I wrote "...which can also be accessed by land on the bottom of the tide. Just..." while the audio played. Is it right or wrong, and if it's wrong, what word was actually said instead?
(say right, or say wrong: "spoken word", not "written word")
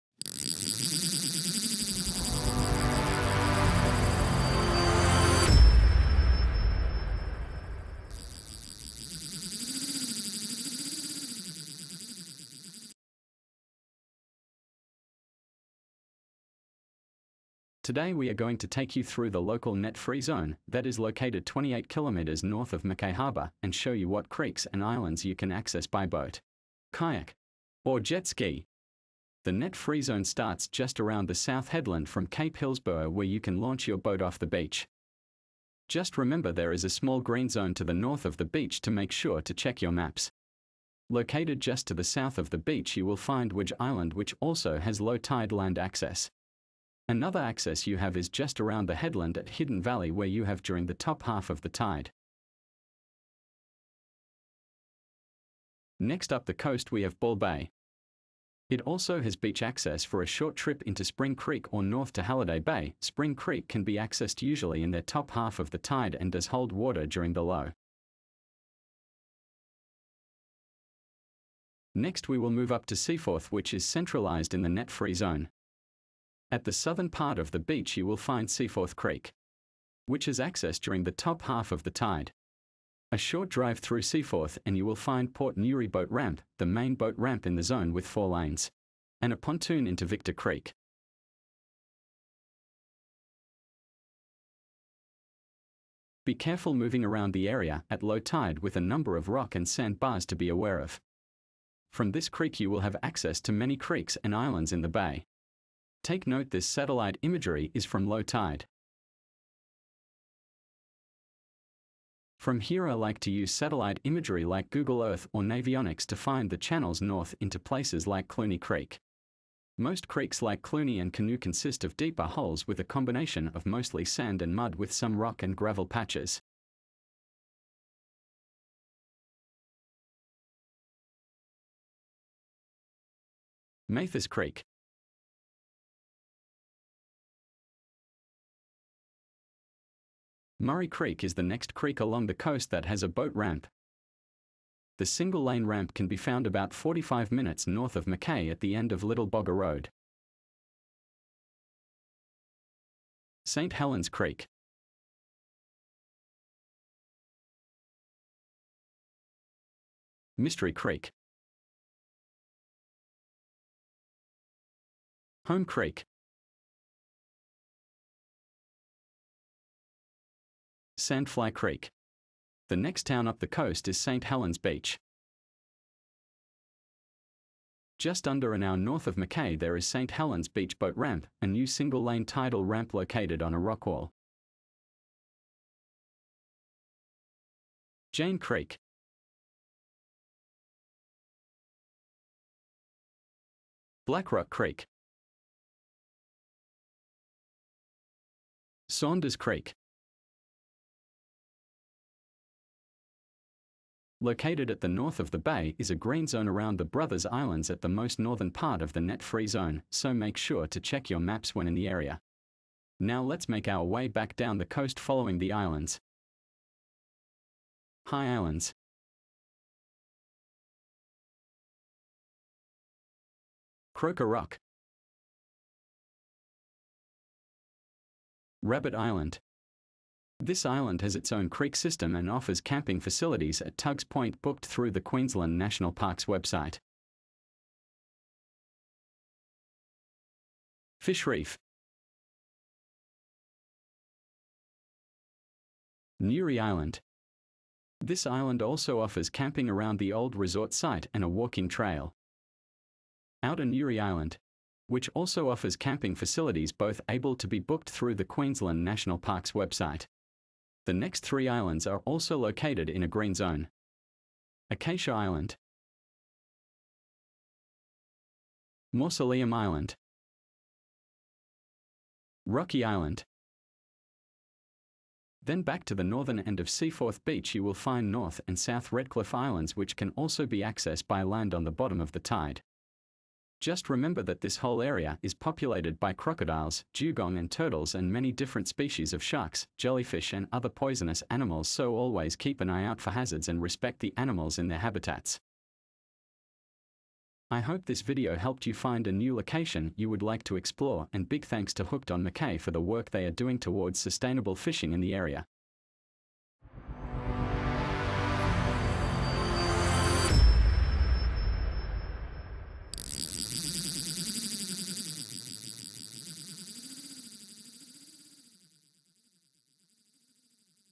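right.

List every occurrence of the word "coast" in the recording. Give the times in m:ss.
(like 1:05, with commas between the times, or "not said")
0:56, 2:22, 2:53, 3:34.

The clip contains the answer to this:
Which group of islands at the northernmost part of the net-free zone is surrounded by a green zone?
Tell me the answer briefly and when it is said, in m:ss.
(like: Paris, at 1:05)
Brothers Islands, at 3:26.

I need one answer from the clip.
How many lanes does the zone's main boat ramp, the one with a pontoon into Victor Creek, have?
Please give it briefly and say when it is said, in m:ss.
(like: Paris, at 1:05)
4, at 1:28.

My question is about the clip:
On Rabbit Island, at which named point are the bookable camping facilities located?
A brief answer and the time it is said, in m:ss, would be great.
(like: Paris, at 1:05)
Tugs Point, at 3:53.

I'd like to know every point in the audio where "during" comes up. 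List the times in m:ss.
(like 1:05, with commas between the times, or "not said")
0:50, 1:07, 1:20.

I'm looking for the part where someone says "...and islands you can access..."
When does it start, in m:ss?
0:24.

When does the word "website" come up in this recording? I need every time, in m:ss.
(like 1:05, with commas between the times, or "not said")
3:56, 4:19.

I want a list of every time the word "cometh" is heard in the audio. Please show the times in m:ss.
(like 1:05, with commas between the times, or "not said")
not said.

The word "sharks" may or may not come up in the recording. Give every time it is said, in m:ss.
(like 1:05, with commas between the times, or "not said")
4:49.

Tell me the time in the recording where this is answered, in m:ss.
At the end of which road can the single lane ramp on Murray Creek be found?
2:29.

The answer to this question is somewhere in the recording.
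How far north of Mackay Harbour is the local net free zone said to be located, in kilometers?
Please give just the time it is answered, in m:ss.
0:21.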